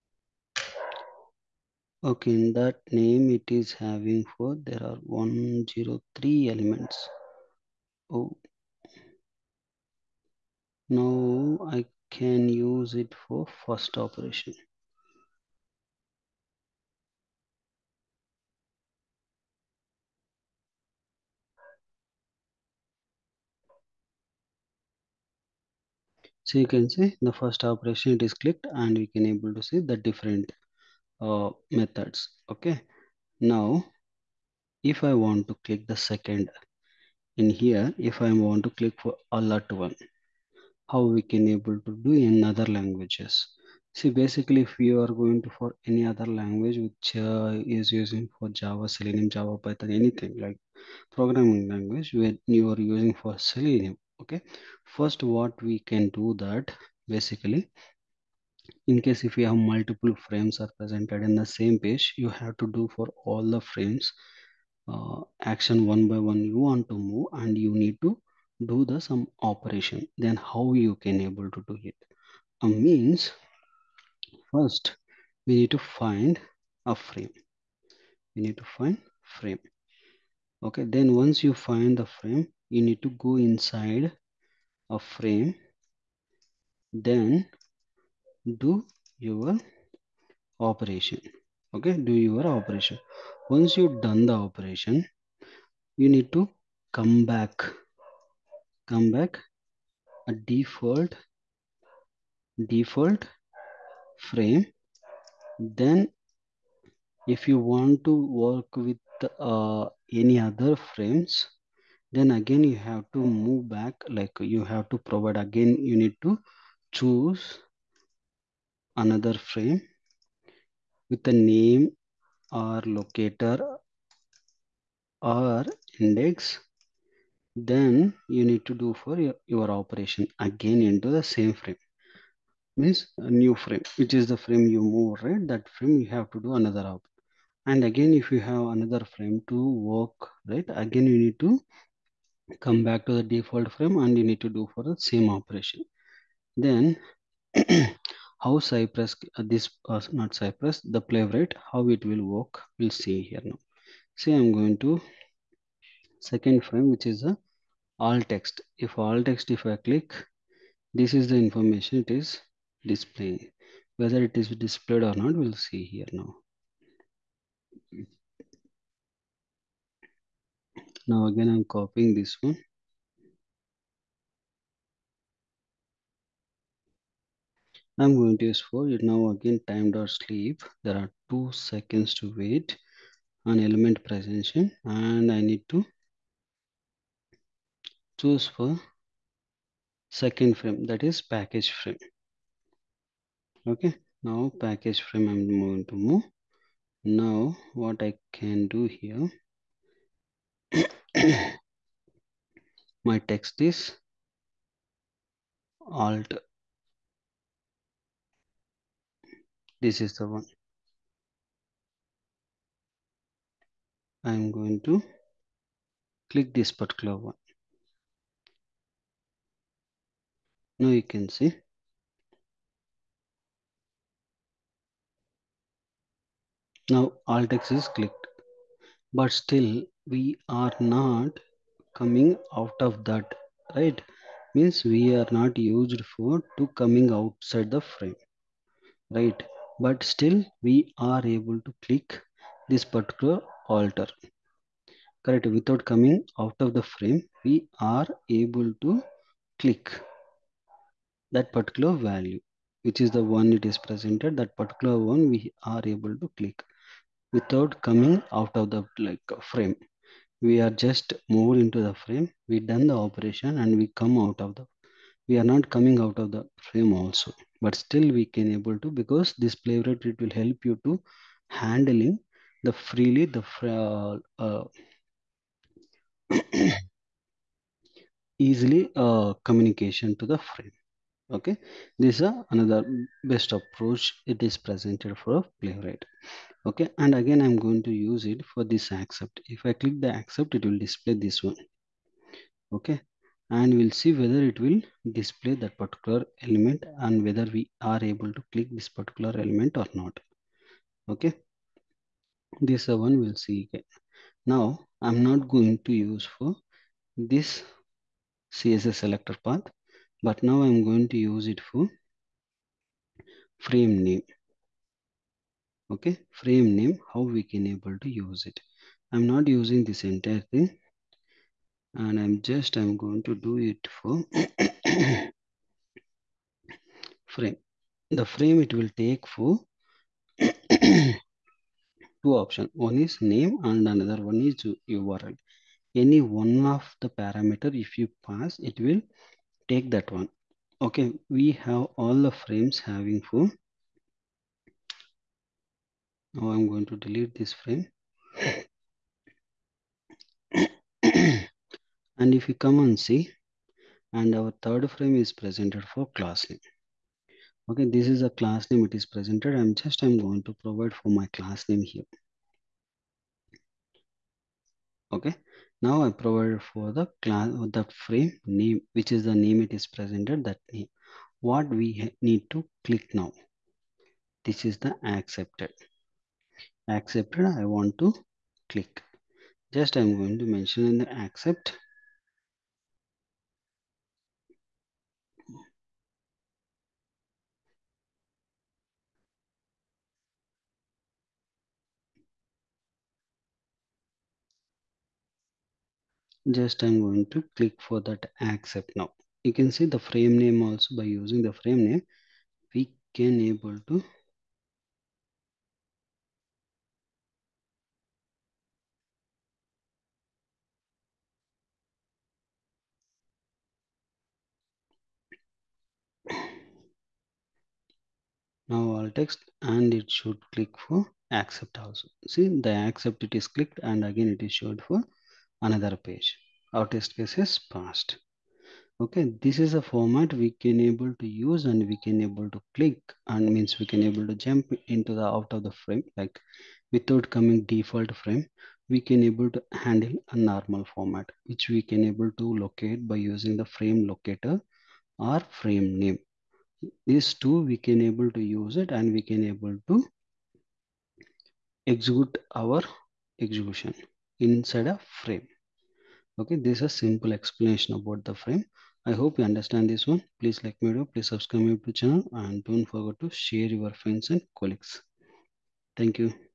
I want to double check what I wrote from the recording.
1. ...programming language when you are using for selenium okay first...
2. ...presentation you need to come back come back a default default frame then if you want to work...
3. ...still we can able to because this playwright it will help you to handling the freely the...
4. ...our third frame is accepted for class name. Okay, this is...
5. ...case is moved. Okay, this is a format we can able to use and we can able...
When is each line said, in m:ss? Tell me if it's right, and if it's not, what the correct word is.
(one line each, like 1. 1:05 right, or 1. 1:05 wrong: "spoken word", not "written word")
1. 0:51 right
2. 1:34 wrong: "operation", not "presentation"
3. 4:27 right
4. 5:54 wrong: "presented", not "accepted"
5. 7:07 wrong: "passed", not "moved".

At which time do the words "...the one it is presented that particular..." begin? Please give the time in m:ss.
4:13.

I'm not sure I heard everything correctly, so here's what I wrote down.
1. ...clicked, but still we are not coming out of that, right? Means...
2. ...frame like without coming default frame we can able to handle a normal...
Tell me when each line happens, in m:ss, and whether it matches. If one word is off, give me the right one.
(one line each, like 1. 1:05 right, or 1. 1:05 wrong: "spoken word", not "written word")
1. 3:47 right
2. 7:15 right.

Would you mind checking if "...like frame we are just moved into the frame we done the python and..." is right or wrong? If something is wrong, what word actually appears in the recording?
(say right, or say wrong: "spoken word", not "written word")
wrong: "operation", not "python".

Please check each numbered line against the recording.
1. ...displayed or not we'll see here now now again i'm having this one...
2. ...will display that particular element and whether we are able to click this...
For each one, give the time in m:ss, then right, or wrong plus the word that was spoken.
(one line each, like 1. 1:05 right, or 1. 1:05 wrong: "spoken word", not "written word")
1. 2:44 wrong: "copying", not "having"
2. 4:54 right.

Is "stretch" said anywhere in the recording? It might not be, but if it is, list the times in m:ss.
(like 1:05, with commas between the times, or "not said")
not said.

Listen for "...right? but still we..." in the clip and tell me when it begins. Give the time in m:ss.
3:59.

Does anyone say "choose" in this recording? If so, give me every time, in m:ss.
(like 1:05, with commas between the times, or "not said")
1:56, 3:08.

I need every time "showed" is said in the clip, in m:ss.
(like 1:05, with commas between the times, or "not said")
7:04.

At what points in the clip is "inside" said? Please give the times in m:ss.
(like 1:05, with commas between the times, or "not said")
1:23, 7:34.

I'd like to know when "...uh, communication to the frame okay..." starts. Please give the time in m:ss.
4:39.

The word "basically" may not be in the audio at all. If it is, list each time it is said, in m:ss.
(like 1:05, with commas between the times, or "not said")
0:44, 0:57.